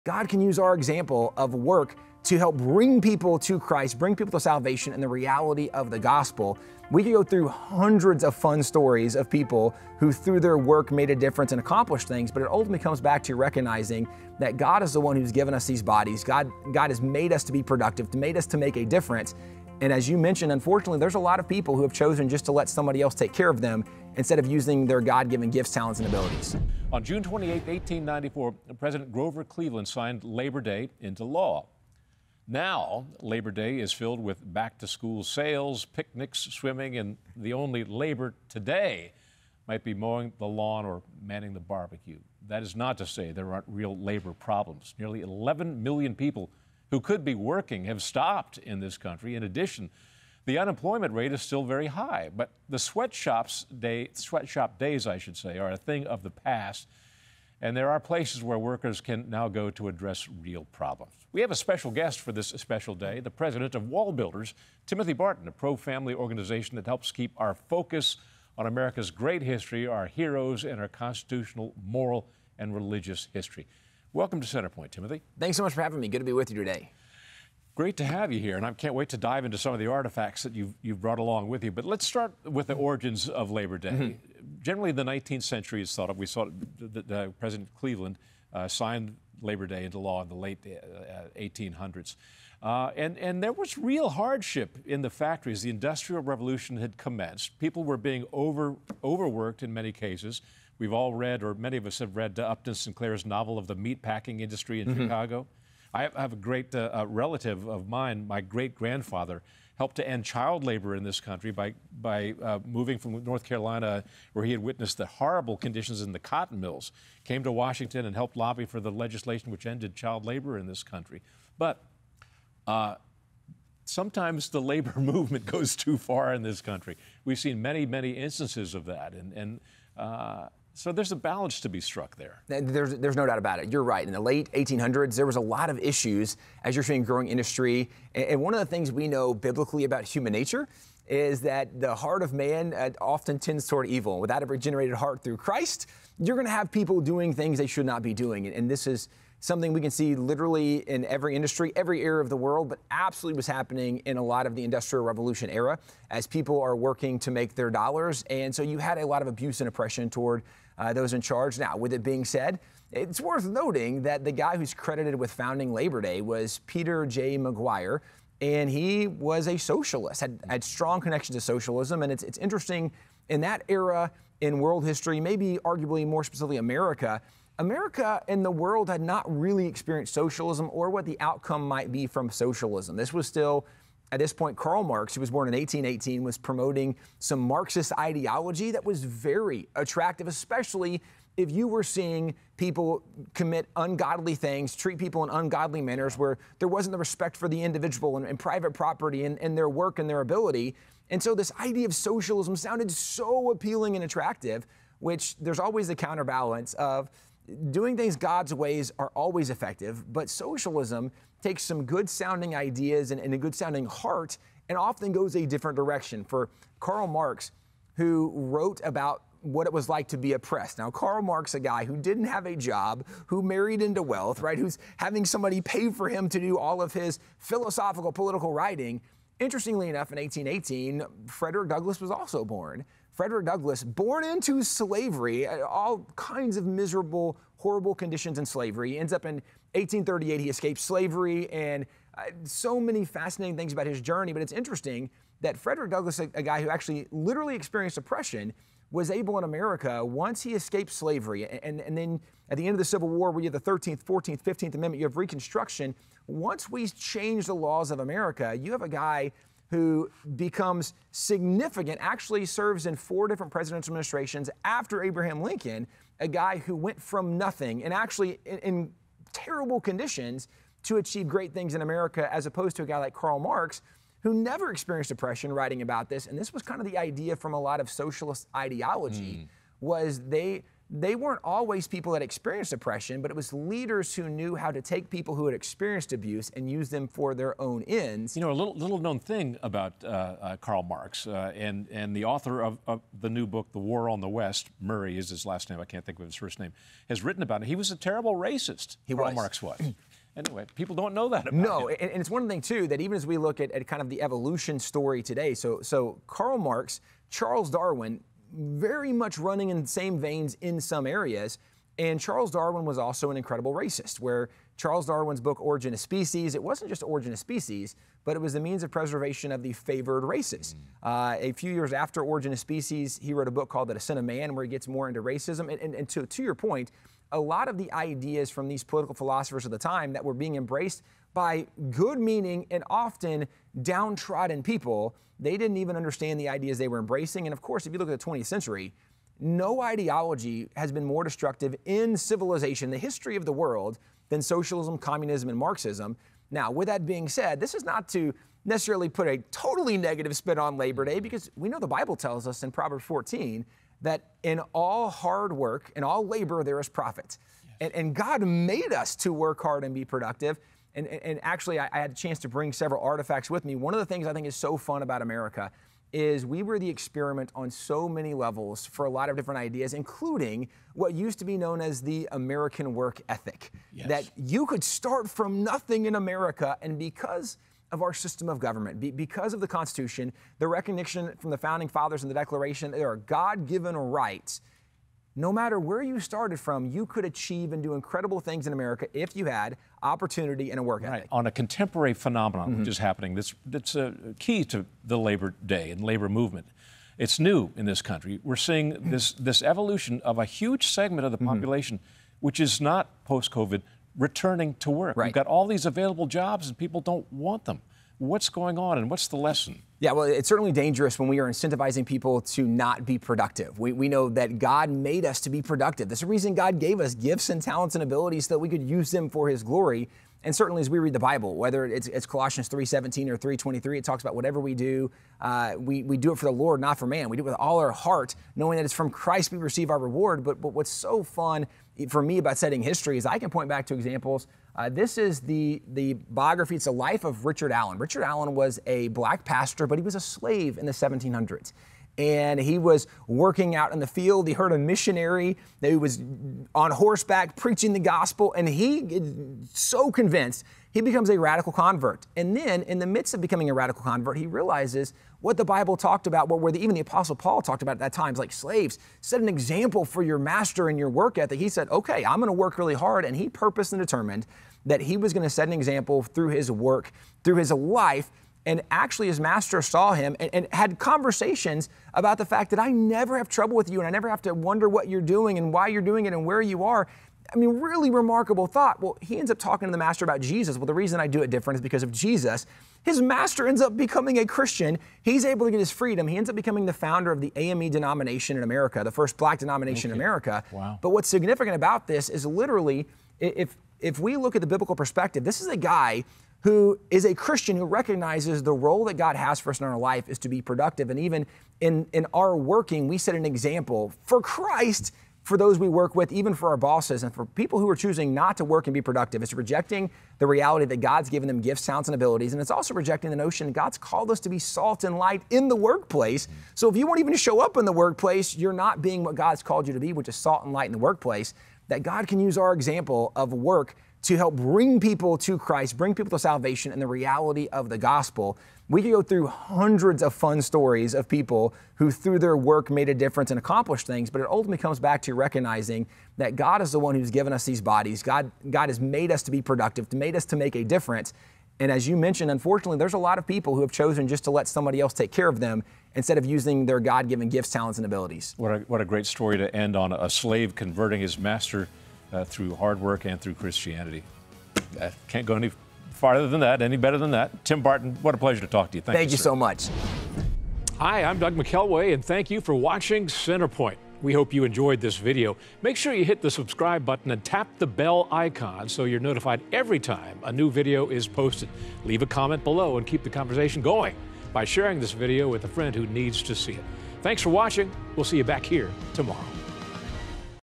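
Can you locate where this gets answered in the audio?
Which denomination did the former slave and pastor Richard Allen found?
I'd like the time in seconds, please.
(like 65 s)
487 s.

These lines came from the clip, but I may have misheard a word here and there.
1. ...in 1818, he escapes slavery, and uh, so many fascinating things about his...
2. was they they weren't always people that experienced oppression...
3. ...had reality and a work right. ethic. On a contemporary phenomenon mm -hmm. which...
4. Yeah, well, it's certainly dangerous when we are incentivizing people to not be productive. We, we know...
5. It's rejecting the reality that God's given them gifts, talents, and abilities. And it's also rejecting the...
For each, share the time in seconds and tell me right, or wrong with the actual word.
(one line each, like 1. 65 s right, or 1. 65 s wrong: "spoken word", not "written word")
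1. 239 s wrong: "1838", not "1818"
2. 279 s right
3. 389 s wrong: "opportunity", not "reality"
4. 409 s right
5. 509 s right.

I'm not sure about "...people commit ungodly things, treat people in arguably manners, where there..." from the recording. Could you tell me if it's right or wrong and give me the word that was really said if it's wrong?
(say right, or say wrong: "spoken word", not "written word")
wrong: "ungodly", not "arguably".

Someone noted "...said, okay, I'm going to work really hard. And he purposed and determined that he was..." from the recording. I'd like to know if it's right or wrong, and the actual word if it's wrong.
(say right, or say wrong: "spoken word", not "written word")
right.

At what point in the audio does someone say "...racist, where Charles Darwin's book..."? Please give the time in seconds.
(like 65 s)
313 s.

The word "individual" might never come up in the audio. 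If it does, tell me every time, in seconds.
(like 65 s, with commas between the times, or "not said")
197 s.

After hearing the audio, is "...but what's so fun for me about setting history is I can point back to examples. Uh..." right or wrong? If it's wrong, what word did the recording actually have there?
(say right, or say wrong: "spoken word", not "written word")
right.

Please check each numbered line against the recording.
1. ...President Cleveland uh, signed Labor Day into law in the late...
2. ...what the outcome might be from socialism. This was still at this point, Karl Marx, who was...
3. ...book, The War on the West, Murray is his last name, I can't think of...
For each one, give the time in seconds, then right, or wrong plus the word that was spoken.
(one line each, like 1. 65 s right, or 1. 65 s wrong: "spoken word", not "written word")
1. 87 s right
2. 180 s right
3. 293 s right.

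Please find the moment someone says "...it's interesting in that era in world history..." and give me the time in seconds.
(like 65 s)
172 s.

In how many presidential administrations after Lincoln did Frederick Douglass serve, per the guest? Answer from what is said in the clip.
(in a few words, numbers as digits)
4.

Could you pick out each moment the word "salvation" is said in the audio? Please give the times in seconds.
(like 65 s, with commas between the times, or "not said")
4 s, 526 s.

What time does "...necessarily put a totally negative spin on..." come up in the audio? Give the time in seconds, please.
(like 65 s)
348 s.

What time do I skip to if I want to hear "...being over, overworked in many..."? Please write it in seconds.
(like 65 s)
97 s.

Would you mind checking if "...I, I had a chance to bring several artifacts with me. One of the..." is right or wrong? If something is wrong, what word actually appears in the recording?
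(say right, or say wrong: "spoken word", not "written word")
right.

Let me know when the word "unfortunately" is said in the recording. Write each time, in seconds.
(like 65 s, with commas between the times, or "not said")
20 s, 542 s.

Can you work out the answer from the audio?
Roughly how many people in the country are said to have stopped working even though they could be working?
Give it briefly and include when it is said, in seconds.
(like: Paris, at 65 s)
11 million, at 45 s.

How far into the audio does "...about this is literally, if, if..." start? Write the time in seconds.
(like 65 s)
491 s.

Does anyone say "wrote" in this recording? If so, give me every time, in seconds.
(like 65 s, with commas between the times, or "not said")
218 s, 323 s.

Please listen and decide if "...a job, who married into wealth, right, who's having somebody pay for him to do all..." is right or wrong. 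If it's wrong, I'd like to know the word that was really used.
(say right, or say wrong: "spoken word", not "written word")
right.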